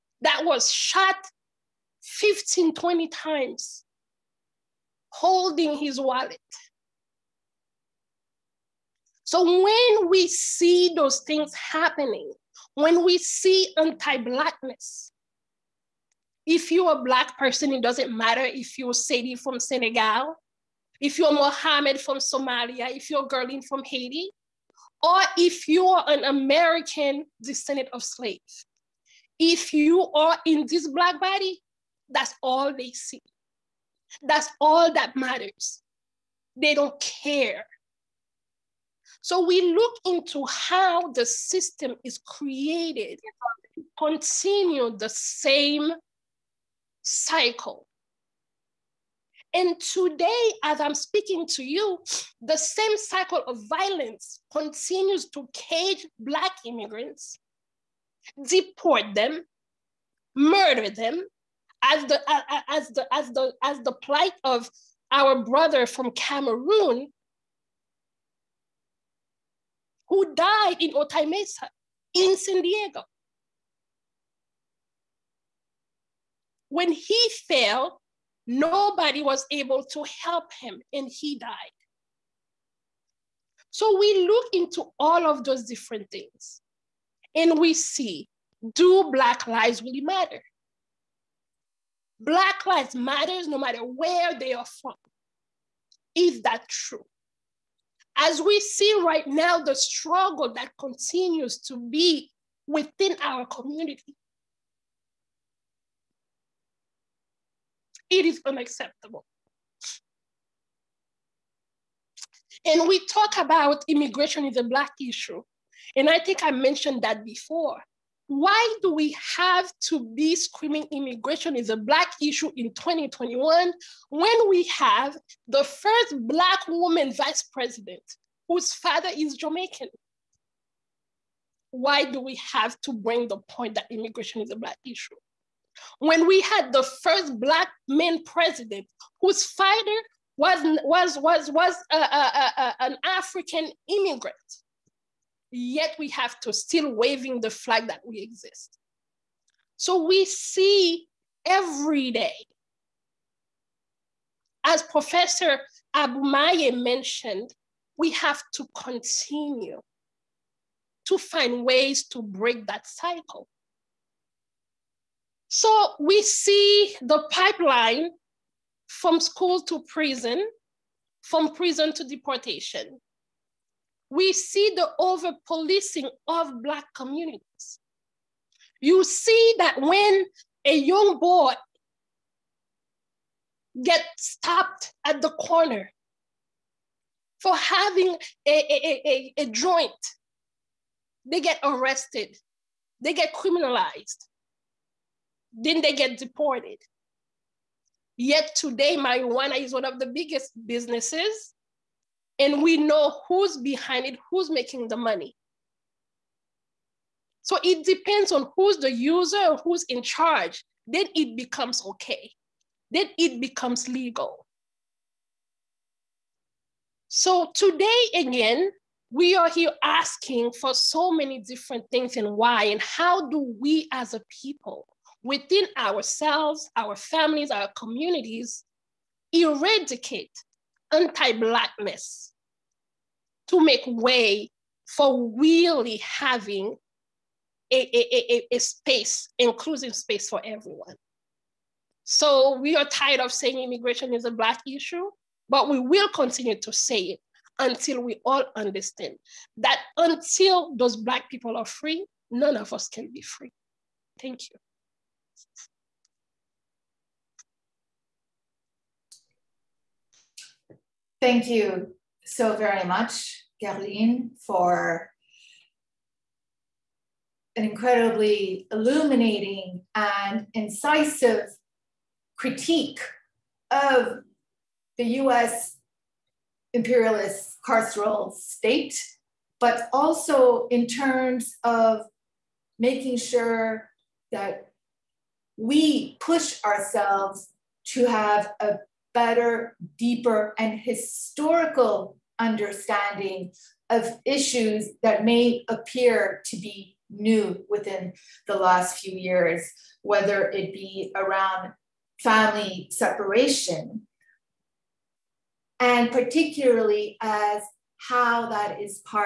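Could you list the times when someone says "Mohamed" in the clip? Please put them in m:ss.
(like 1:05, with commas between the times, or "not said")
0:21.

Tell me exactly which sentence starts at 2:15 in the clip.
when we had the first black man president whose fighter was, was, was, was a, a, a, an African immigrant.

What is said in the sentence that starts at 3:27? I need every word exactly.
So it depends on who's the user, who's in charge.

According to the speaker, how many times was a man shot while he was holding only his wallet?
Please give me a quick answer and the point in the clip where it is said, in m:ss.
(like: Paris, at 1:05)
15, 20, at 0:02.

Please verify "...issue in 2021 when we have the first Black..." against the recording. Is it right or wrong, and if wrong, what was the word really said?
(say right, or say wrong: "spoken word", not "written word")
right.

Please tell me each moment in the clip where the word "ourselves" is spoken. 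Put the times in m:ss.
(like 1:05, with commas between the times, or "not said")
3:45, 4:46.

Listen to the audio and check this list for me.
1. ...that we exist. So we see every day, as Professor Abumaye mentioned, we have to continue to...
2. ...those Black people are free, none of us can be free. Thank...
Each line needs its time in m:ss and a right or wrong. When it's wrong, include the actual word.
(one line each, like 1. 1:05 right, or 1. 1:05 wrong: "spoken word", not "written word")
1. 2:27 right
2. 4:10 right.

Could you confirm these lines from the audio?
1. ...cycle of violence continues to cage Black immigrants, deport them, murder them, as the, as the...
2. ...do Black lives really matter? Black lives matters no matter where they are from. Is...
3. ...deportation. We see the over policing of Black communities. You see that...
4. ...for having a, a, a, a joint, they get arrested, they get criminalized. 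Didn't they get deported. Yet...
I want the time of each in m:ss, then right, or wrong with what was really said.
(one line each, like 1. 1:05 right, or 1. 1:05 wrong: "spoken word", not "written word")
1. 0:52 right
2. 1:28 right
3. 2:52 right
4. 3:07 right.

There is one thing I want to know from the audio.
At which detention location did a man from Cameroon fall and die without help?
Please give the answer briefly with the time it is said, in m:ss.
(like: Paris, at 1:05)
Otay Mesa, at 1:10.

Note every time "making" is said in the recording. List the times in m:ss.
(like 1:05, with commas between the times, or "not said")
3:24, 4:42.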